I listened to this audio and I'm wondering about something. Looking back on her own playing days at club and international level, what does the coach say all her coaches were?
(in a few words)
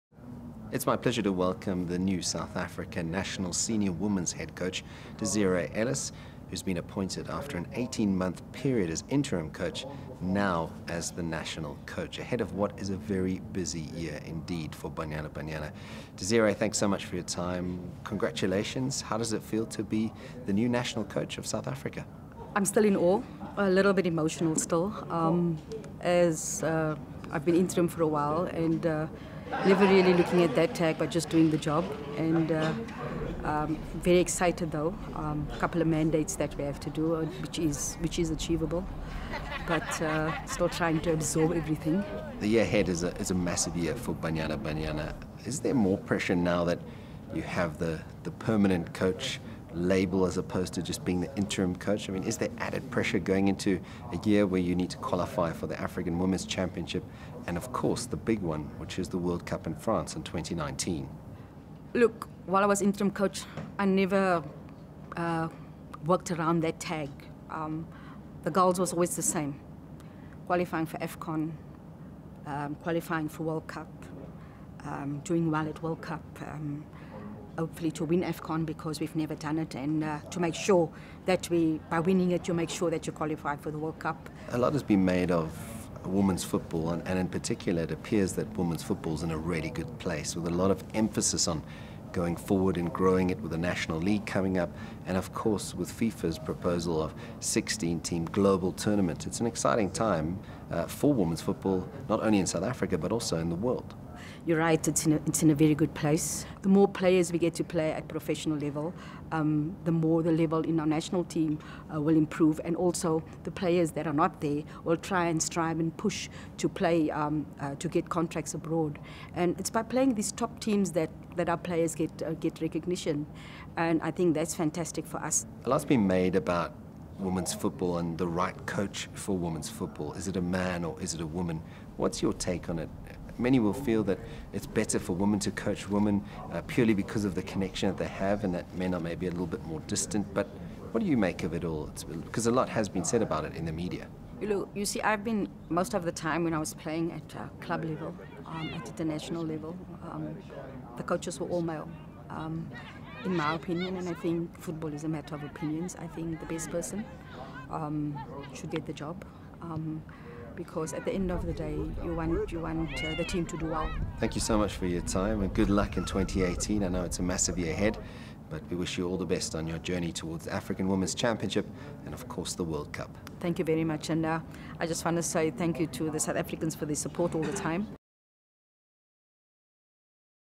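Male.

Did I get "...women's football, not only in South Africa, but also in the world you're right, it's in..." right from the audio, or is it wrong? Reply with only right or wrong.
right.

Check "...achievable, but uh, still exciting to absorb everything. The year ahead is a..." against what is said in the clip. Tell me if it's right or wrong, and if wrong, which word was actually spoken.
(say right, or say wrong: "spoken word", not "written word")
wrong: "trying", not "exciting".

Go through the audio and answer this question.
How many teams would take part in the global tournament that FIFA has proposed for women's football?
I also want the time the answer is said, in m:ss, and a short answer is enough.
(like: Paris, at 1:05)
16, at 1:37.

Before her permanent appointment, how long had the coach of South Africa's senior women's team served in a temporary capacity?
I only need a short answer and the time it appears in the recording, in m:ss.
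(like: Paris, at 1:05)
18 months, at 0:07.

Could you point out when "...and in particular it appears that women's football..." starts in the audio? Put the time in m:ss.
1:27.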